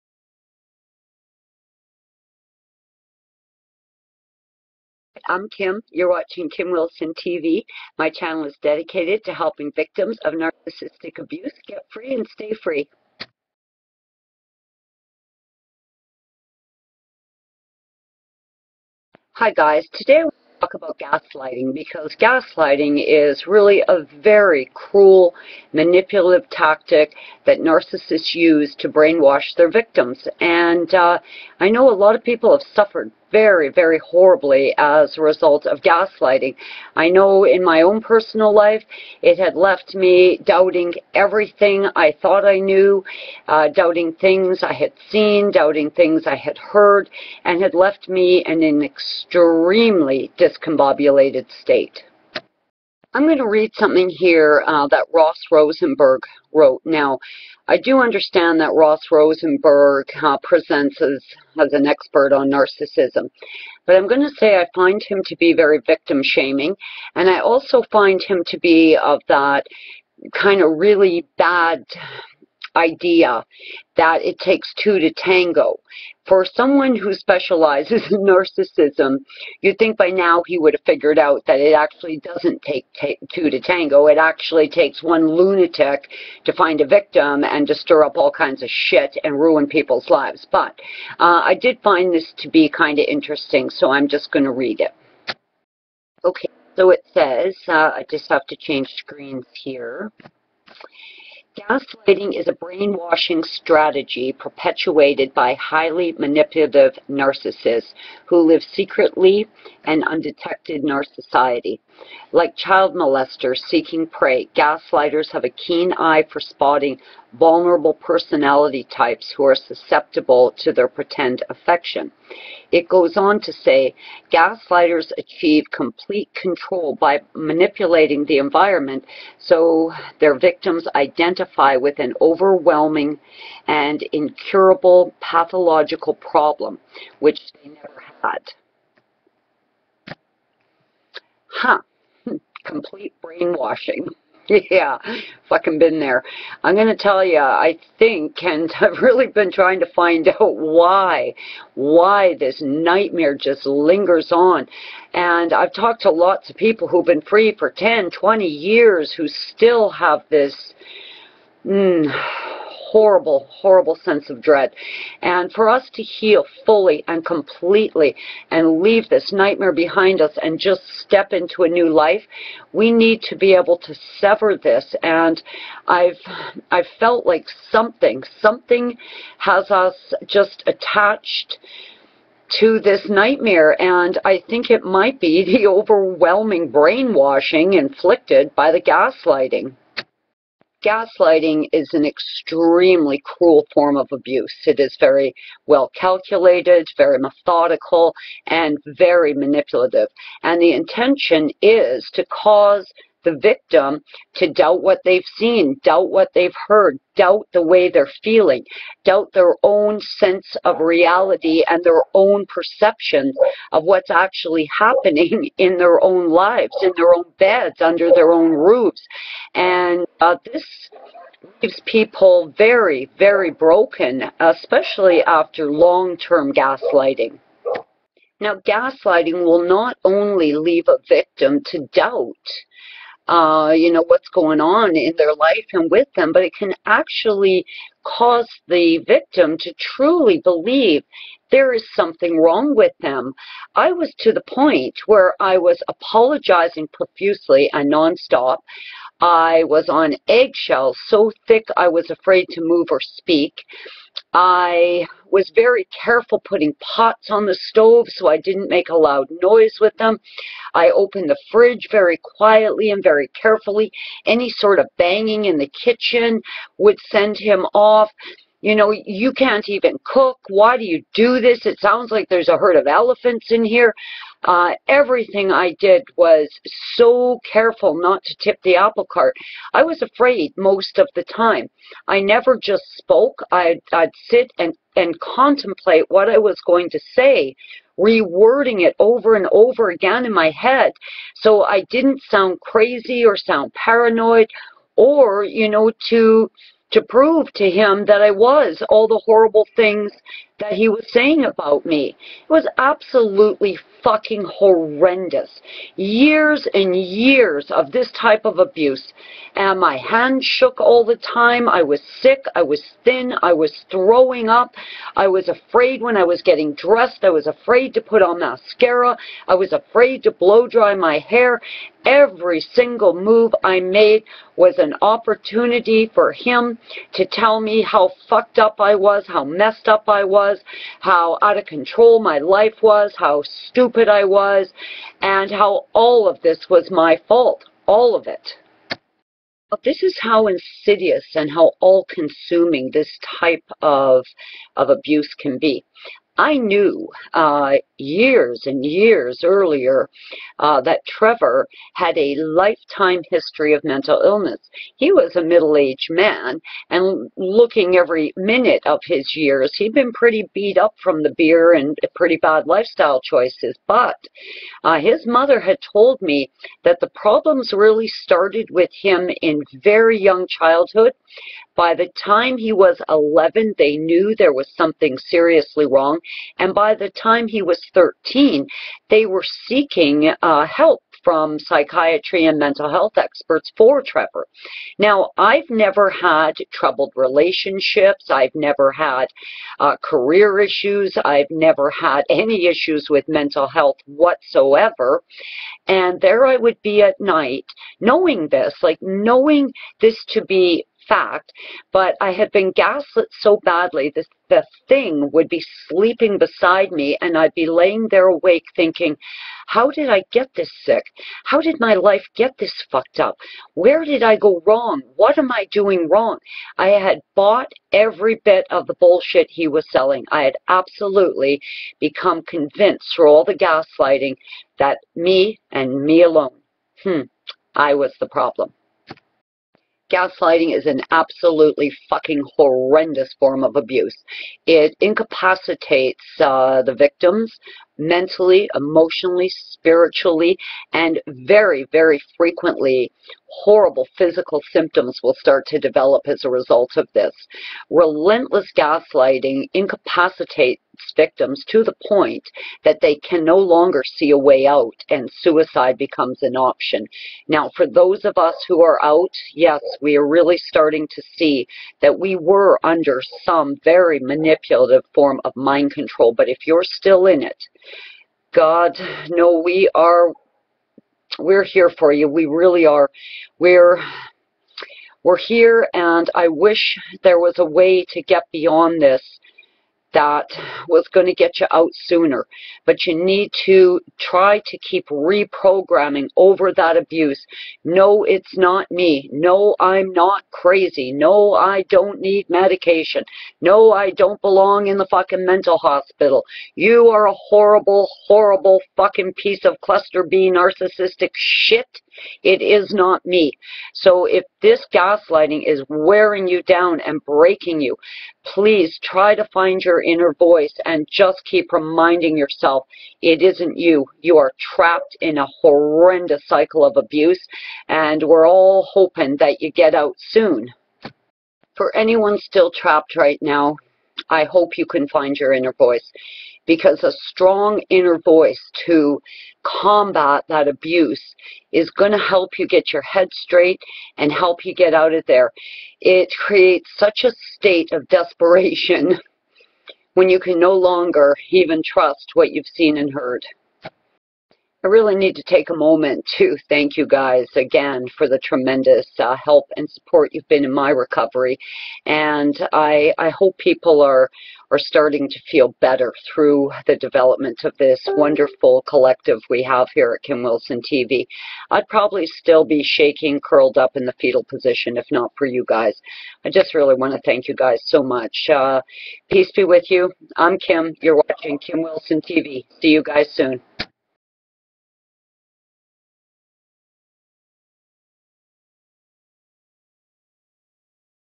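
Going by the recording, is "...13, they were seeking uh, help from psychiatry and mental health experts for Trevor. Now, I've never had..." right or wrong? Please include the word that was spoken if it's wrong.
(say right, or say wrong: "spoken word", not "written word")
right.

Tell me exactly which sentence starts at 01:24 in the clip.
It actually takes one lunatic to find a victim and to stir up all kinds of shit and ruin people's lives.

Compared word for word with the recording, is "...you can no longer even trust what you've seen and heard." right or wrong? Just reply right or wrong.
right.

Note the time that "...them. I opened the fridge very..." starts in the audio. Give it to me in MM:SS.
04:19.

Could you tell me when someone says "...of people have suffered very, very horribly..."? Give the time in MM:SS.
00:32.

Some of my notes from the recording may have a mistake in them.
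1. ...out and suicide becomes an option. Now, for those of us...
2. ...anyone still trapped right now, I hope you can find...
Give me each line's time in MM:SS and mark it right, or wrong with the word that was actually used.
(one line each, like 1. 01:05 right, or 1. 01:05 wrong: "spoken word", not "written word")
1. 07:34 right
2. 08:41 right.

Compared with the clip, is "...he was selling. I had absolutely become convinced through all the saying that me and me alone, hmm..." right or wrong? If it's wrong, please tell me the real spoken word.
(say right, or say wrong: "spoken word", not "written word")
wrong: "gaslighting", not "saying".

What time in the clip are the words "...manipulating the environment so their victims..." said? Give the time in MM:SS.
02:07.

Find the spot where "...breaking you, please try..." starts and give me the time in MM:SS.
08:27.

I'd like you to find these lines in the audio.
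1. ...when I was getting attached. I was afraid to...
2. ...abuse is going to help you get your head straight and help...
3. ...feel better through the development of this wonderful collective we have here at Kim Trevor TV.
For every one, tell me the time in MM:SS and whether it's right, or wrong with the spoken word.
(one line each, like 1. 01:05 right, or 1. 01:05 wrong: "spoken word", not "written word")
1. 05:16 wrong: "dressed", not "attached"
2. 08:50 right
3. 09:15 wrong: "Wilson", not "Trevor".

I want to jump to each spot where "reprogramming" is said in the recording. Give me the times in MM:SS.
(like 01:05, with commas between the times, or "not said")
08:05.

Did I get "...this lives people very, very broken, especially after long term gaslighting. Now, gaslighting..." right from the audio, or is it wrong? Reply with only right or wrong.
wrong.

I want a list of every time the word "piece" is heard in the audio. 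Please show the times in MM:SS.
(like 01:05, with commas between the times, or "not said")
08:19.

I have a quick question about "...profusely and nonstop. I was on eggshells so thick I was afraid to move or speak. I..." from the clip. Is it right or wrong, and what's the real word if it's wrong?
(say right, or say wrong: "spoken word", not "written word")
right.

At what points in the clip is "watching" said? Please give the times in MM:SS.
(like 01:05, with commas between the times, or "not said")
00:06, 09:31.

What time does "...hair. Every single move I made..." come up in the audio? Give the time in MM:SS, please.
05:21.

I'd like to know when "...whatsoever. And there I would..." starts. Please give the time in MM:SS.
06:34.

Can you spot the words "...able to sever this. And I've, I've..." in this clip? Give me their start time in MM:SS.
02:53.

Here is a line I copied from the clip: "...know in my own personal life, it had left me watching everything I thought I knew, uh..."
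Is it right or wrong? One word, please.
wrong.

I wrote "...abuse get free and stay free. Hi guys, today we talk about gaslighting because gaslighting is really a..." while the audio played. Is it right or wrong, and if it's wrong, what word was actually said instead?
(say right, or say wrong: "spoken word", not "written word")
right.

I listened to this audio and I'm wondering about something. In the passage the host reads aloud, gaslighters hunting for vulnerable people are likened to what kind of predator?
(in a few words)
Child molesters.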